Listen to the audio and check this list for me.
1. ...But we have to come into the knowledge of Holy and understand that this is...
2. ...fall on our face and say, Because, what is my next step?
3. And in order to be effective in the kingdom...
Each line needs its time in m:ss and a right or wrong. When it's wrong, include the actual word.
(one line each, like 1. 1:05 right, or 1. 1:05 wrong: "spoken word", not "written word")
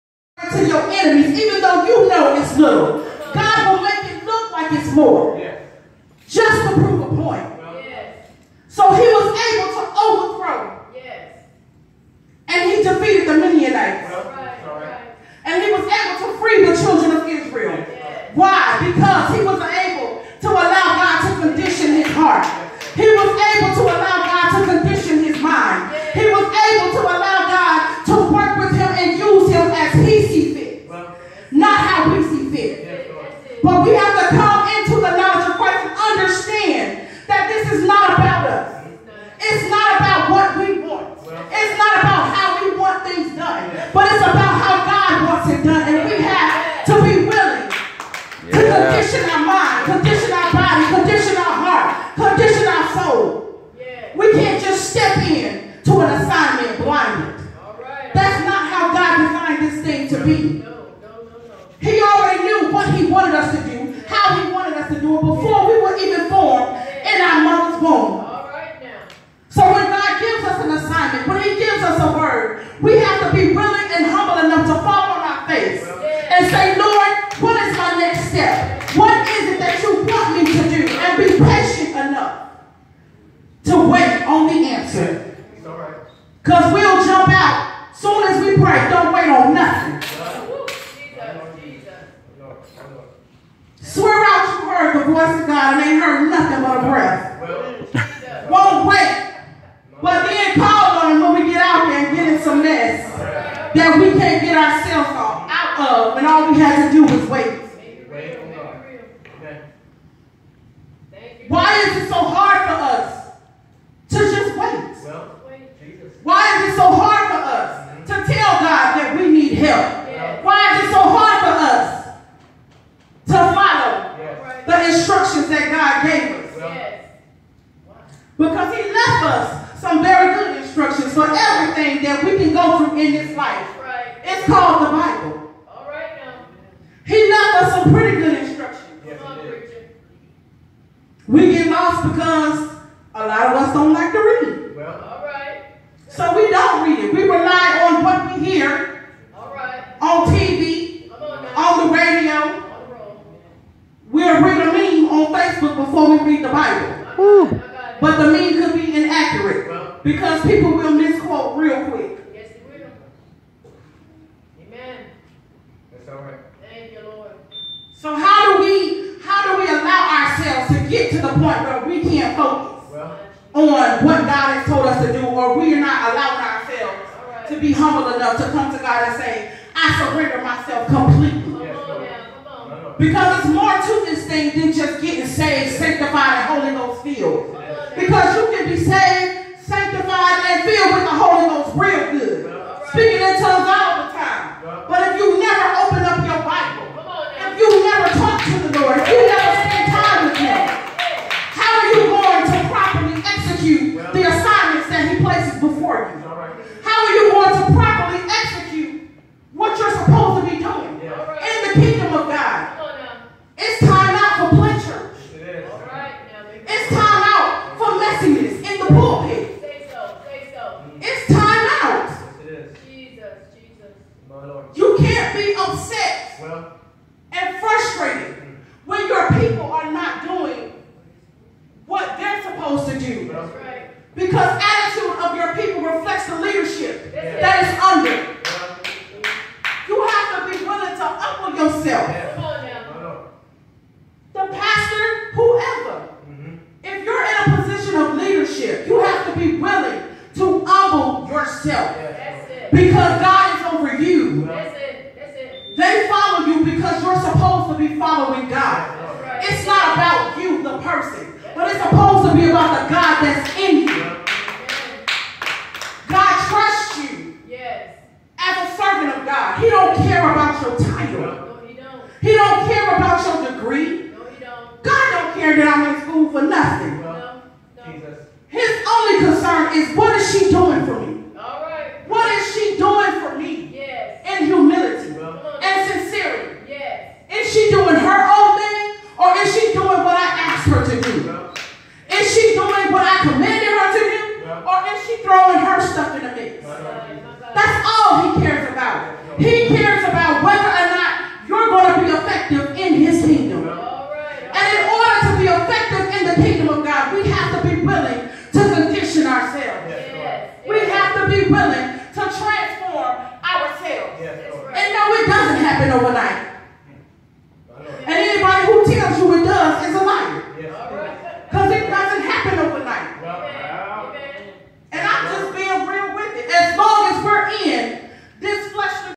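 1. 0:33 wrong: "Christ", not "Holy"
2. 1:14 wrong: "Lord", not "Because"
3. 5:03 right.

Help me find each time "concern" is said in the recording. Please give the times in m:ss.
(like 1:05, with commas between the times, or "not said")
4:39.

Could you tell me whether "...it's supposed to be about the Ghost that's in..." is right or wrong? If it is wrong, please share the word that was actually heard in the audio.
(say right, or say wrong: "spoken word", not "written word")
wrong: "God", not "Ghost".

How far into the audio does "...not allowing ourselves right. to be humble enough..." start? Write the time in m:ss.
2:55.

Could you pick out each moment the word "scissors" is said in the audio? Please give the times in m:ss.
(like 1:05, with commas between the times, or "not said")
not said.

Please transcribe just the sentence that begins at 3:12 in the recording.
Speaking in tongues all the time.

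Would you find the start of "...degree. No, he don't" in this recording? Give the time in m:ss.
4:33.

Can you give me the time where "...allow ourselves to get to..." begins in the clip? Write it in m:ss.
2:49.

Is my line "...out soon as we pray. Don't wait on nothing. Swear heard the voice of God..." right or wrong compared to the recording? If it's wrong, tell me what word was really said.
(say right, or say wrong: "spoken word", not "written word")
right.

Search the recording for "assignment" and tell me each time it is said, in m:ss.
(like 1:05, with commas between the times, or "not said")
0:56, 1:10, 3:24.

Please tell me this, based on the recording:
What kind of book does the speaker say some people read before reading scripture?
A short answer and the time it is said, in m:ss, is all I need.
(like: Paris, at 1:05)
Textbook, at 2:35.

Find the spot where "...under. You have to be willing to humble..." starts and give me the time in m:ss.
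3:57.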